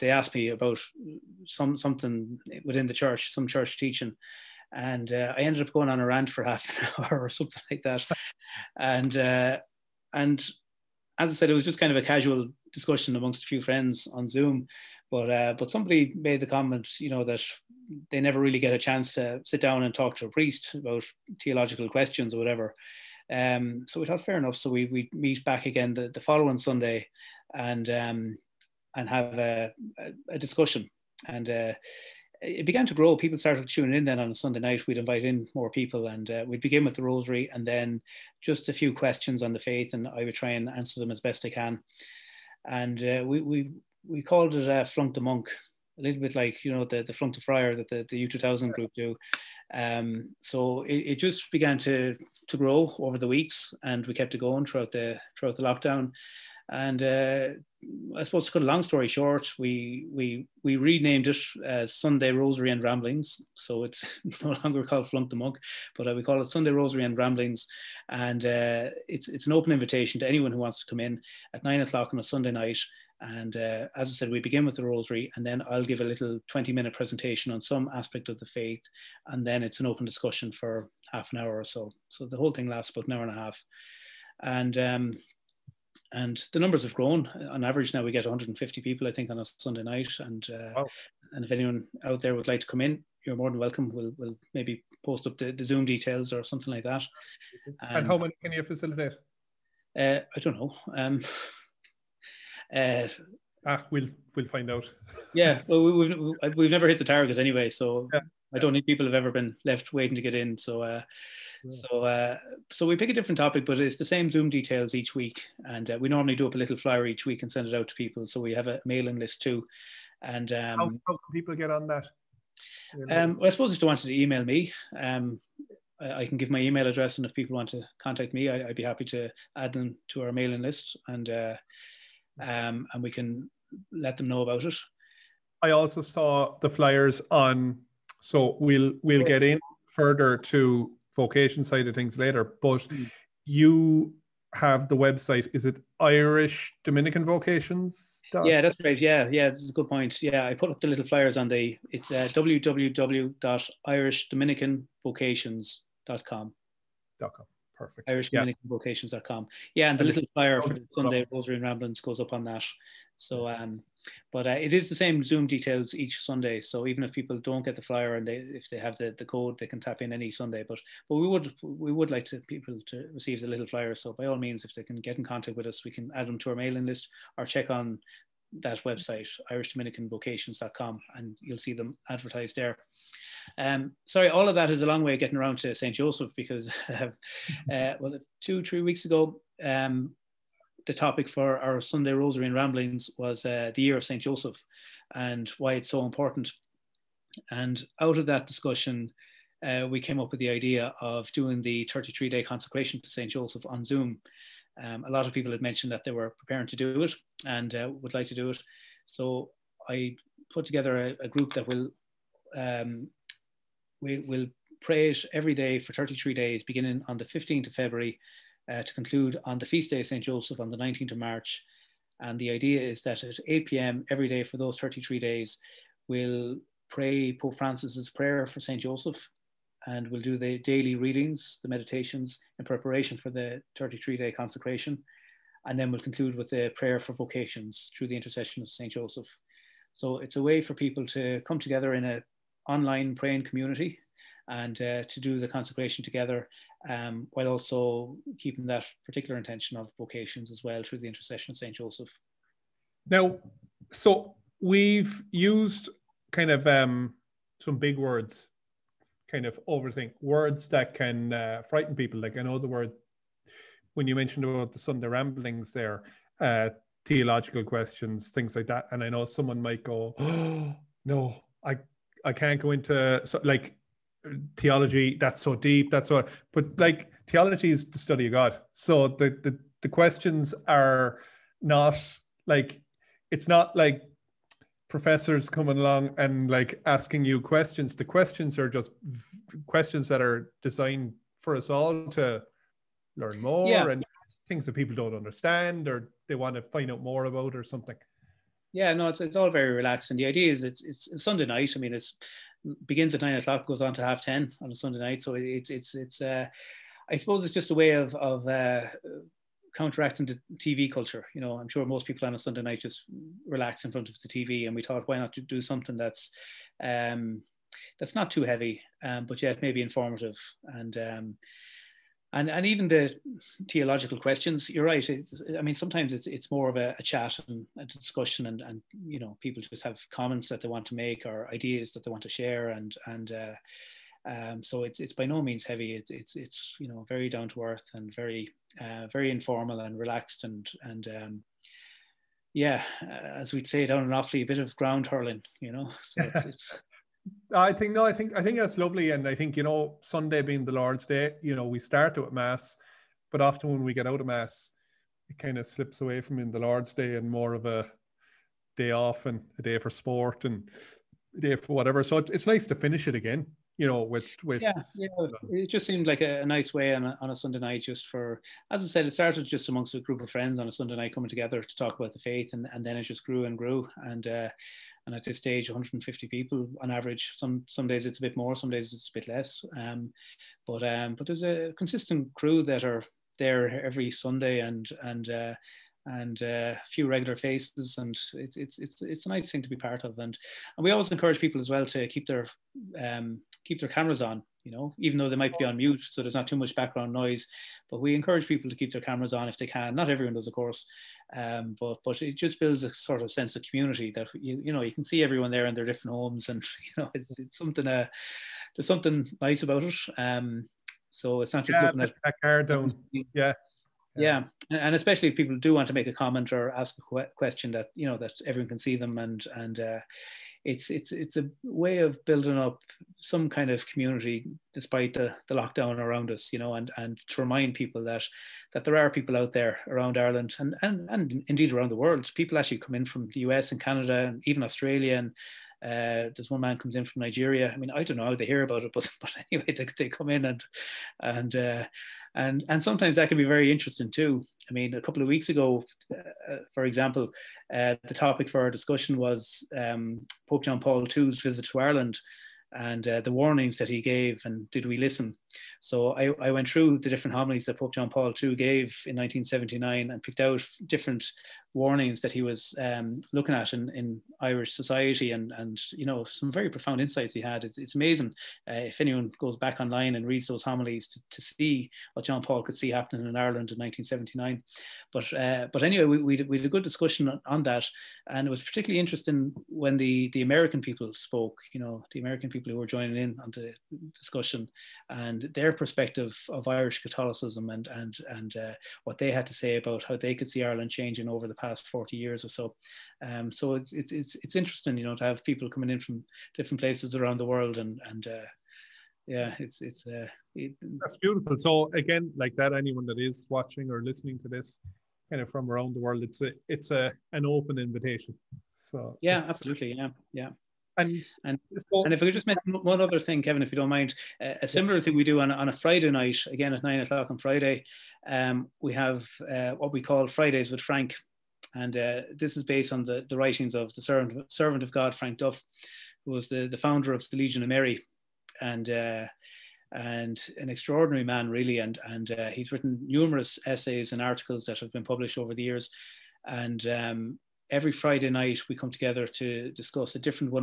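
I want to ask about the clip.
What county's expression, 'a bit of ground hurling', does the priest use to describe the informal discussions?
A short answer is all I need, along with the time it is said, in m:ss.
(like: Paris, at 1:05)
Offaly, at 5:44.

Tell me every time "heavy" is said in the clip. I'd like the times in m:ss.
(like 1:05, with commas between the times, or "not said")
5:18, 5:35.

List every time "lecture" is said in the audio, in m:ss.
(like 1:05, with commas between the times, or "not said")
not said.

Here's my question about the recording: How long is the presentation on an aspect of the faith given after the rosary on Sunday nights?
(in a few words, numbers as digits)
20 minutes.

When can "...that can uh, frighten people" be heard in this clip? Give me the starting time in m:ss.
4:20.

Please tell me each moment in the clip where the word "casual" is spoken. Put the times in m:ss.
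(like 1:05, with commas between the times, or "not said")
0:12.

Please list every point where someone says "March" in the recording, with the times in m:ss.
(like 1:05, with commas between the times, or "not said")
3:41.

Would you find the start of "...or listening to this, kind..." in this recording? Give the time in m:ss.
8:23.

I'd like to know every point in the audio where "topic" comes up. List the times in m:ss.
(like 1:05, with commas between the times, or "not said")
1:53, 3:10, 7:28.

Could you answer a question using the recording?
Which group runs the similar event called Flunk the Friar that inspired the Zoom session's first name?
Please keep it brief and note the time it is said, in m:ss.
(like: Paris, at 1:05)
Youth 2000, at 0:48.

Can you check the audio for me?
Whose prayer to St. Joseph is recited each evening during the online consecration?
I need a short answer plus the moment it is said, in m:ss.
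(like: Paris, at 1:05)
Pope Francis, at 3:47.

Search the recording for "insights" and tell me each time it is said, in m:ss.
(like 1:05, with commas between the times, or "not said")
7:47.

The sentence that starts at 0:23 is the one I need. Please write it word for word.
Um, so we thought fair enough.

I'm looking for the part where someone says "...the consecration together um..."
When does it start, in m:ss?
4:05.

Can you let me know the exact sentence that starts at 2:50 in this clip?
But but we would we would like to people to receive the little flyer.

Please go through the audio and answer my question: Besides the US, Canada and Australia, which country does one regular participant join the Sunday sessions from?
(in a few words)
Nigeria.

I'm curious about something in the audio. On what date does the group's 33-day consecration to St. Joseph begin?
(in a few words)
15th of February.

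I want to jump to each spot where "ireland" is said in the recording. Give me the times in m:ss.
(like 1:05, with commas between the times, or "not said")
7:10, 7:31, 7:53, 8:10.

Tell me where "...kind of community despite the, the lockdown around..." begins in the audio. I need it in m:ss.
7:03.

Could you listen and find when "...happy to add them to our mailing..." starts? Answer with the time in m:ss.
2:08.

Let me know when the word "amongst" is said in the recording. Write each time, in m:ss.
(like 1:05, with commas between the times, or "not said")
0:13, 6:09.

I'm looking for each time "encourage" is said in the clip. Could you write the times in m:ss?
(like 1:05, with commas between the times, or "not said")
6:31, 6:38.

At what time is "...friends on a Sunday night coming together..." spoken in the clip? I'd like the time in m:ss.
6:10.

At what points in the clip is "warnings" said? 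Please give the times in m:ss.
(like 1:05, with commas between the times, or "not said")
7:33, 7:41.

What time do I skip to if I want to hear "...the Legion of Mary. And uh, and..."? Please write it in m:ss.
8:47.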